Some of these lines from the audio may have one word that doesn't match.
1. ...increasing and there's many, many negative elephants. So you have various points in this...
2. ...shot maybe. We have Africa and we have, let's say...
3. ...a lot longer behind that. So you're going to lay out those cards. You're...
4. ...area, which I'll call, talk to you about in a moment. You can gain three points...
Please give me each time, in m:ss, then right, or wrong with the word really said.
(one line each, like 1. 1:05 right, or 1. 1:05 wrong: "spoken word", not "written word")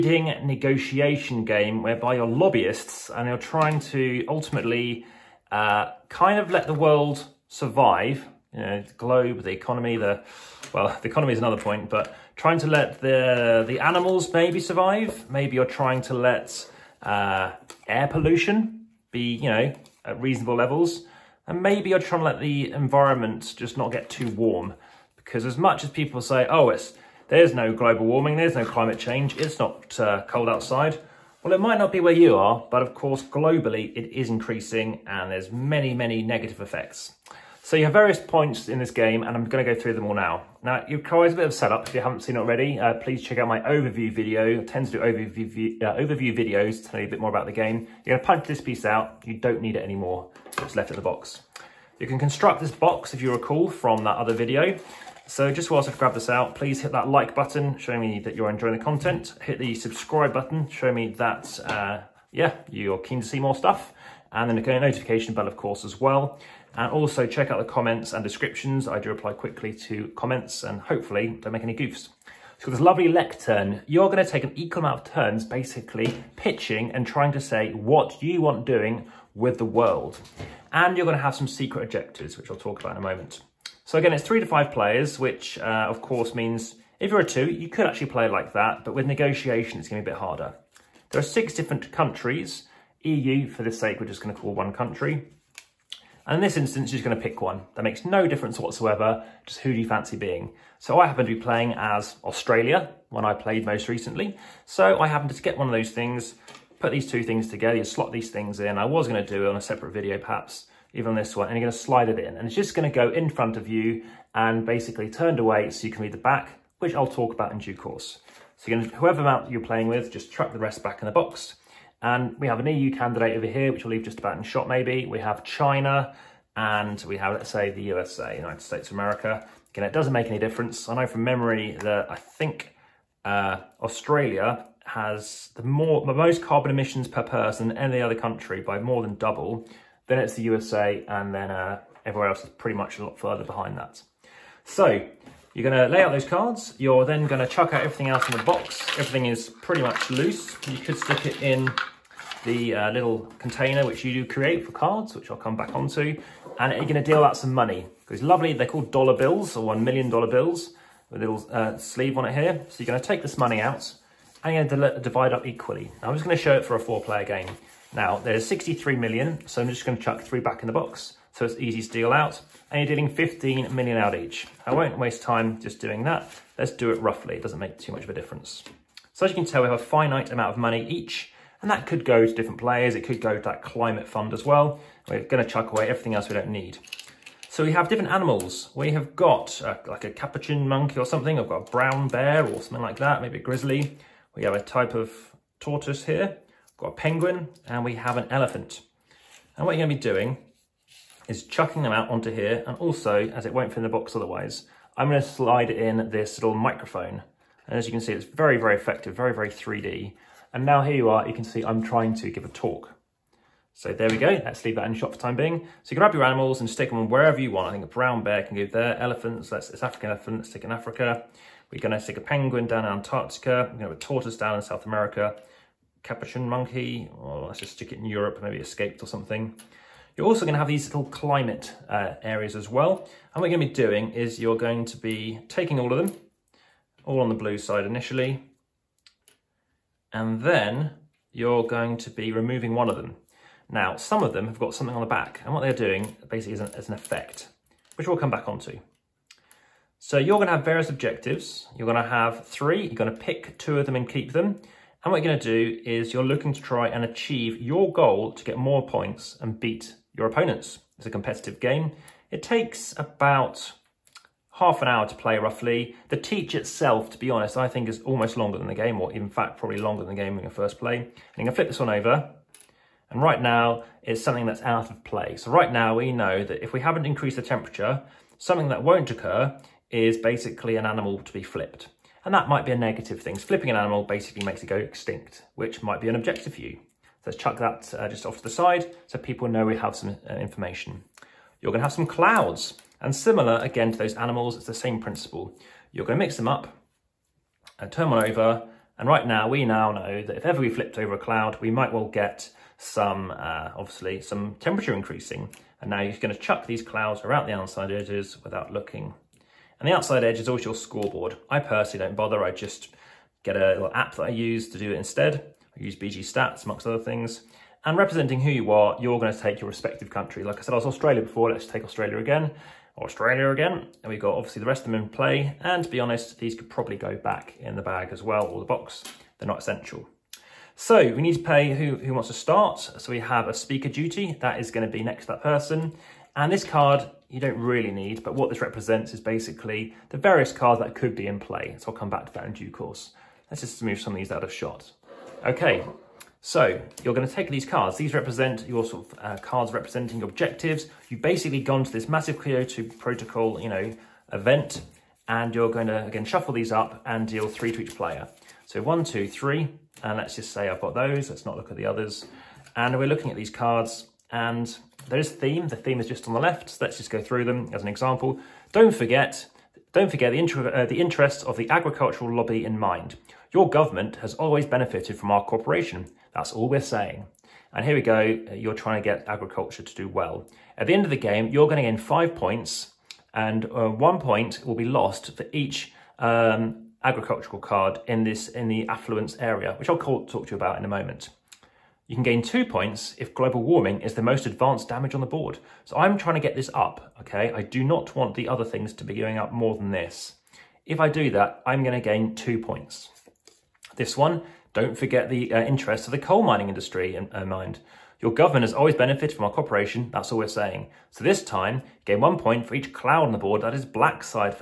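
1. 0:34 wrong: "effects", not "elephants"
2. 2:04 wrong: "China", not "Africa"
3. 2:22 wrong: "further", not "longer"
4. 6:29 wrong: "two", not "three".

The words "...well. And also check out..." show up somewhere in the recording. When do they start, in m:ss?
1:05.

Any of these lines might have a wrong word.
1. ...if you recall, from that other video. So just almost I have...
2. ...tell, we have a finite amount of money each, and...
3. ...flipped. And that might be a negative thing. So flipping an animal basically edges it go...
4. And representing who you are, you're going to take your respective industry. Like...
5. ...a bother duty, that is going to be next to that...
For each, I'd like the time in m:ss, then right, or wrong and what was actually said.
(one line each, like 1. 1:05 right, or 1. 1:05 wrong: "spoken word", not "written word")
1. 0:53 wrong: "whilst", not "almost"
2. 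2:59 right
3. 4:41 wrong: "makes", not "edges"
4. 5:17 wrong: "country", not "industry"
5. 5:33 wrong: "speaker", not "bother".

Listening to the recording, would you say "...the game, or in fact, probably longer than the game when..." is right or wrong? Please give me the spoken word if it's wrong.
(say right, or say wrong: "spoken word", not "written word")
right.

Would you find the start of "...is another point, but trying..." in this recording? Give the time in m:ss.
0:11.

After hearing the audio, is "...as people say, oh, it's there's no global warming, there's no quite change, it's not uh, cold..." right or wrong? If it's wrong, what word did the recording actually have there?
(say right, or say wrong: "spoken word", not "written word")
wrong: "climate", not "quite".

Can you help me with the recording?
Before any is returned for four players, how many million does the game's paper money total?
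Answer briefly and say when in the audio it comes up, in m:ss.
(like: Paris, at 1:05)
63 million, at 2:48.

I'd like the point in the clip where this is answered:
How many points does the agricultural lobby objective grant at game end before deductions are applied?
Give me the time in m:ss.
6:21.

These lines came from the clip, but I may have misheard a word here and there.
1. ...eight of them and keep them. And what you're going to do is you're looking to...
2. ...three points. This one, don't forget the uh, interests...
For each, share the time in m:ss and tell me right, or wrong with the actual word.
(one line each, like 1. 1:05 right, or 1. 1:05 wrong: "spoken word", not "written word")
1. 4:13 wrong: "two", not "eight"
2. 6:42 wrong: "two", not "three".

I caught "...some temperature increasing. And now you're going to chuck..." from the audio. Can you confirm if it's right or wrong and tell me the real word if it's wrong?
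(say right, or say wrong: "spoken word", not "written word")
right.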